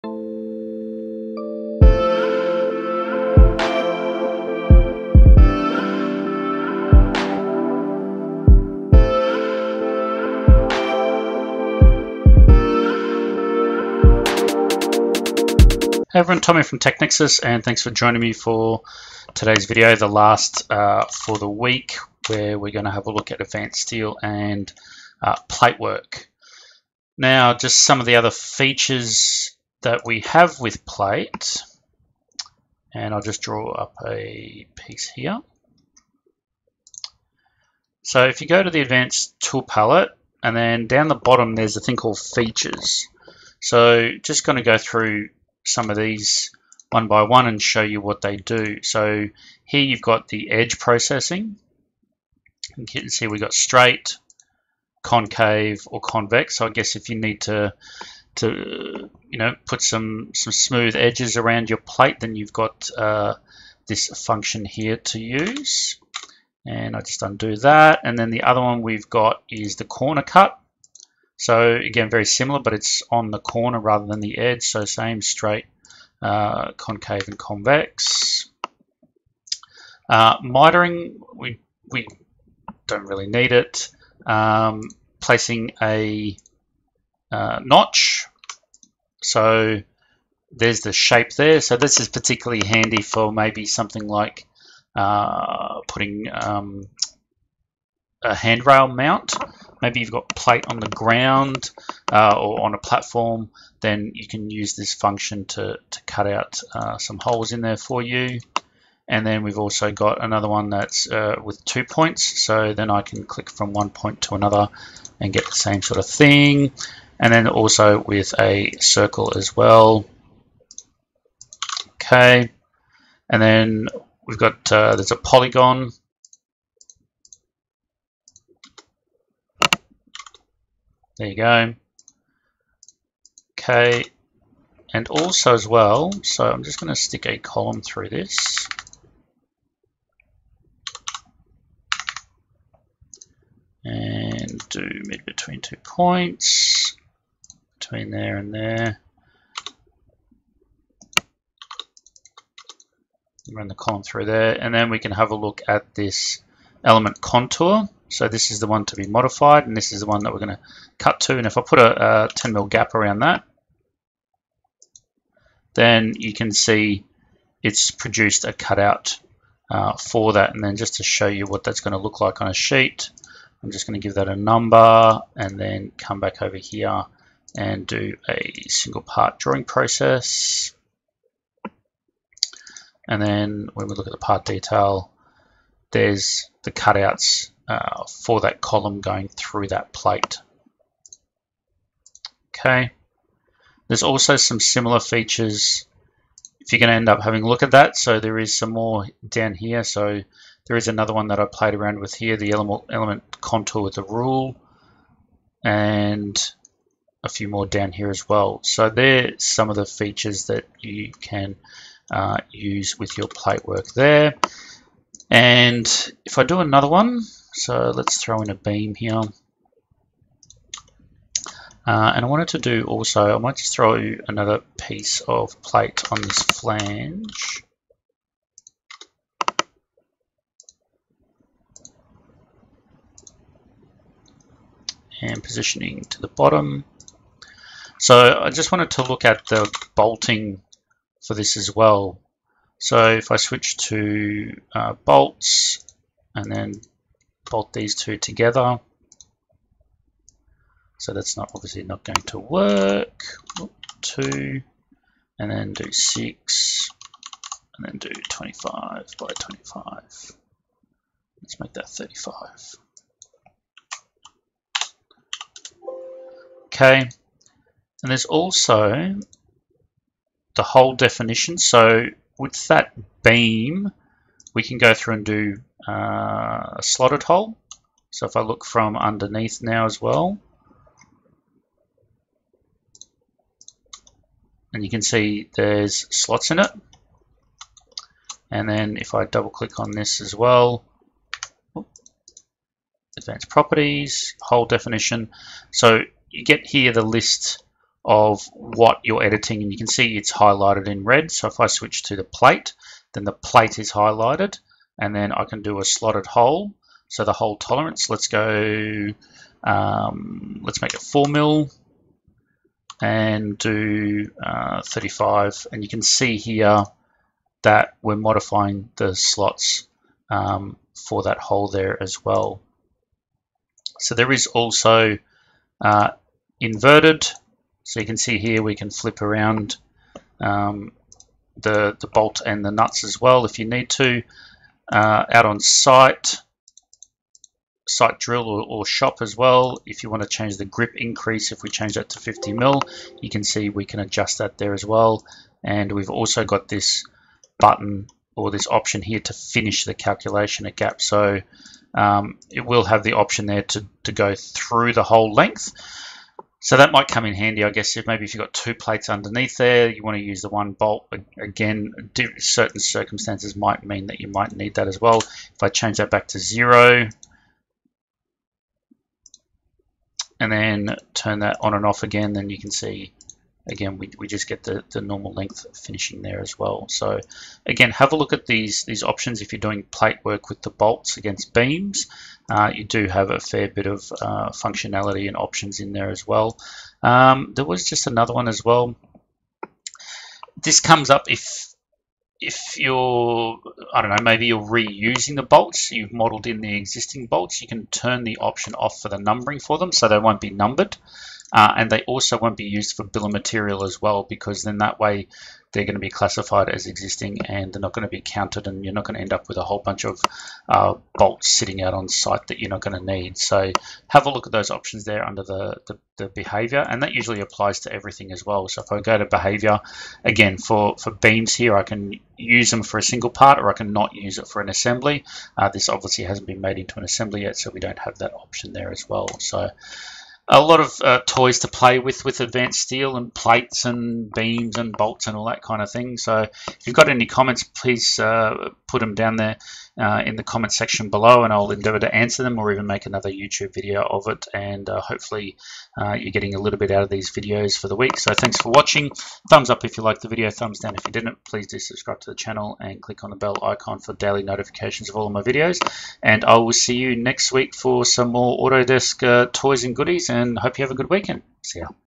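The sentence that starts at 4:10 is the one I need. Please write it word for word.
So that's not obviously not going to work.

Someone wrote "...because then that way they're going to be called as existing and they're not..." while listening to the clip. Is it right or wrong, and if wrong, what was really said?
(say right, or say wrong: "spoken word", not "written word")
wrong: "classified", not "called".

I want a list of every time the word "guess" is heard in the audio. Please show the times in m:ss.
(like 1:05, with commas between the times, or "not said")
0:56, 5:57.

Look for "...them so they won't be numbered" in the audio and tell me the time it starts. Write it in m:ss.
6:39.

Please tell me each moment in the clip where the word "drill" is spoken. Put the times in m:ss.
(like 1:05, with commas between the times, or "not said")
5:38.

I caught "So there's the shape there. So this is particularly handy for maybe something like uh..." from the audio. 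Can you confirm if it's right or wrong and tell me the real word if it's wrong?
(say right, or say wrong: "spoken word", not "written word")
right.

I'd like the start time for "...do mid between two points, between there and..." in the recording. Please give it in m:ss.
2:24.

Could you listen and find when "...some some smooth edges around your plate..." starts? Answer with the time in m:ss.
0:59.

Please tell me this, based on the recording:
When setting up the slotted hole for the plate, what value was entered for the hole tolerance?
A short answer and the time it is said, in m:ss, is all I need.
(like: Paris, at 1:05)
4 mm, at 5:11.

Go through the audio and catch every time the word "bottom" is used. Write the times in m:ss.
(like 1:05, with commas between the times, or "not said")
0:41, 3:56.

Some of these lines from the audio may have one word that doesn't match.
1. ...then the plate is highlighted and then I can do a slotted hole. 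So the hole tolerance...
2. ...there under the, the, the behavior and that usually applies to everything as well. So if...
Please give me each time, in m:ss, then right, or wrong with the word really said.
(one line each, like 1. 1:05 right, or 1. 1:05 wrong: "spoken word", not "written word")
1. 5:03 right
2. 6:55 right.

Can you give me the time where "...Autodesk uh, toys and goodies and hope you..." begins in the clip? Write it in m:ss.
7:38.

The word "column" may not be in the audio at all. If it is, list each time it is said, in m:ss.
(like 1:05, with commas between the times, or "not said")
2:17, 2:33, 3:08.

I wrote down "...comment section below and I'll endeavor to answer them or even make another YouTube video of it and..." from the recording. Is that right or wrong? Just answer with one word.
right.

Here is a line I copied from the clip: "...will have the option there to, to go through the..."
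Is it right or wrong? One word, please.
right.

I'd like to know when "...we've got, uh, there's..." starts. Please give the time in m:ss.
2:04.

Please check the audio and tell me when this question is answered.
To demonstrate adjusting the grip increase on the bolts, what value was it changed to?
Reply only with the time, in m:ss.
5:42.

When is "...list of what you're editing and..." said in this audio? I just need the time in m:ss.
4:57.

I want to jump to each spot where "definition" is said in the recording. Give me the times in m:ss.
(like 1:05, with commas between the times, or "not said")
4:30, 4:54.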